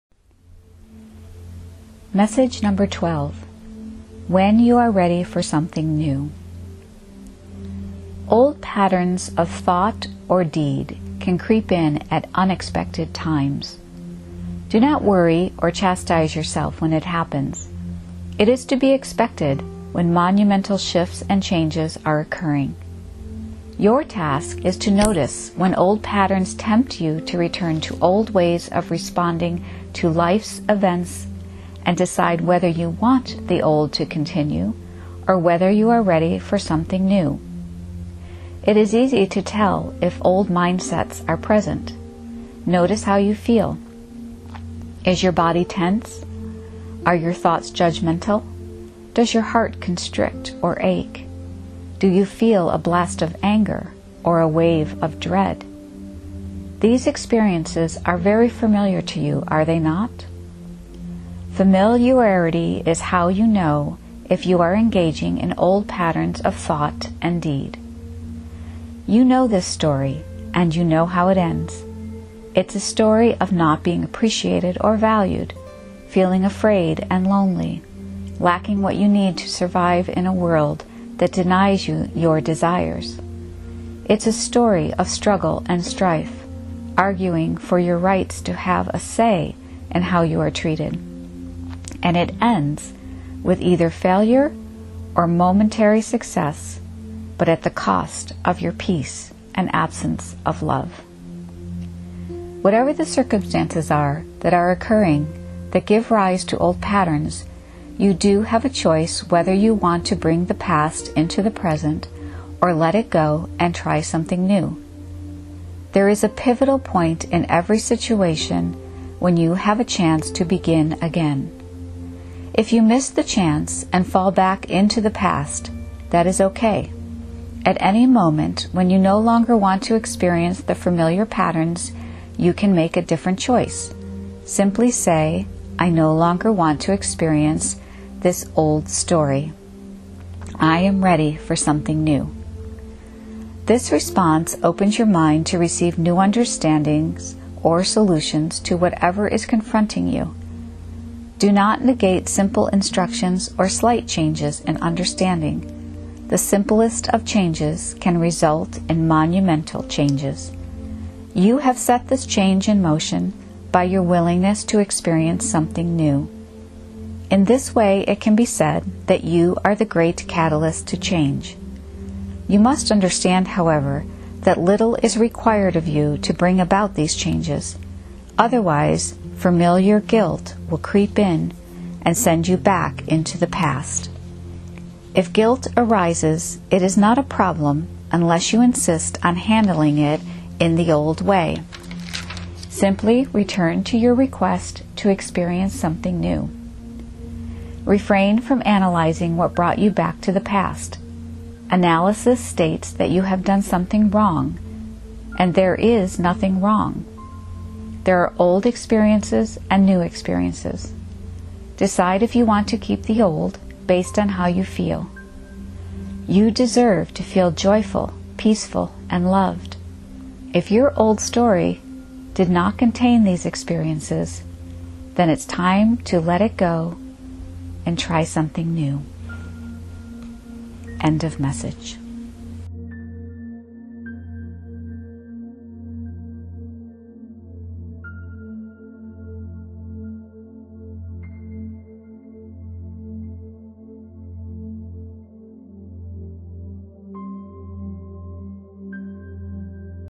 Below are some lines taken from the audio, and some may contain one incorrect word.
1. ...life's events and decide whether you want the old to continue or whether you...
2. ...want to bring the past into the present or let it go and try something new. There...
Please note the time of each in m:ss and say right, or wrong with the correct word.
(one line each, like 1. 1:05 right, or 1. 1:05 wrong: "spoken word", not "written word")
1. 0:30 right
2. 1:49 right.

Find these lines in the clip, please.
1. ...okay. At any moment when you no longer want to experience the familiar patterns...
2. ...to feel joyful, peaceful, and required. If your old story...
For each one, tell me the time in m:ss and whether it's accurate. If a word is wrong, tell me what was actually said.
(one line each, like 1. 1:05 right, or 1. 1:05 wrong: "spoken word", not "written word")
1. 2:06 right
2. 3:37 wrong: "loved", not "required".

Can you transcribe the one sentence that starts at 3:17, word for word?
Refrain from analyzing what brought you back to the past.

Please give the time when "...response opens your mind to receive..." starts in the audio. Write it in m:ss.
2:23.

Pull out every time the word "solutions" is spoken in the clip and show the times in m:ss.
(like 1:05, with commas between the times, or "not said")
2:27.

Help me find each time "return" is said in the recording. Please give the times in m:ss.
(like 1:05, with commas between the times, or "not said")
0:27, 3:13.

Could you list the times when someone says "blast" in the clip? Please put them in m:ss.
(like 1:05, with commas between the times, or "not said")
0:52.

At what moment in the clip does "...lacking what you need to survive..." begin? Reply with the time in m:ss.
1:18.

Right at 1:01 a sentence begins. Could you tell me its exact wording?
Familiarity is how you know if you are engaging in old patterns of thought and deed.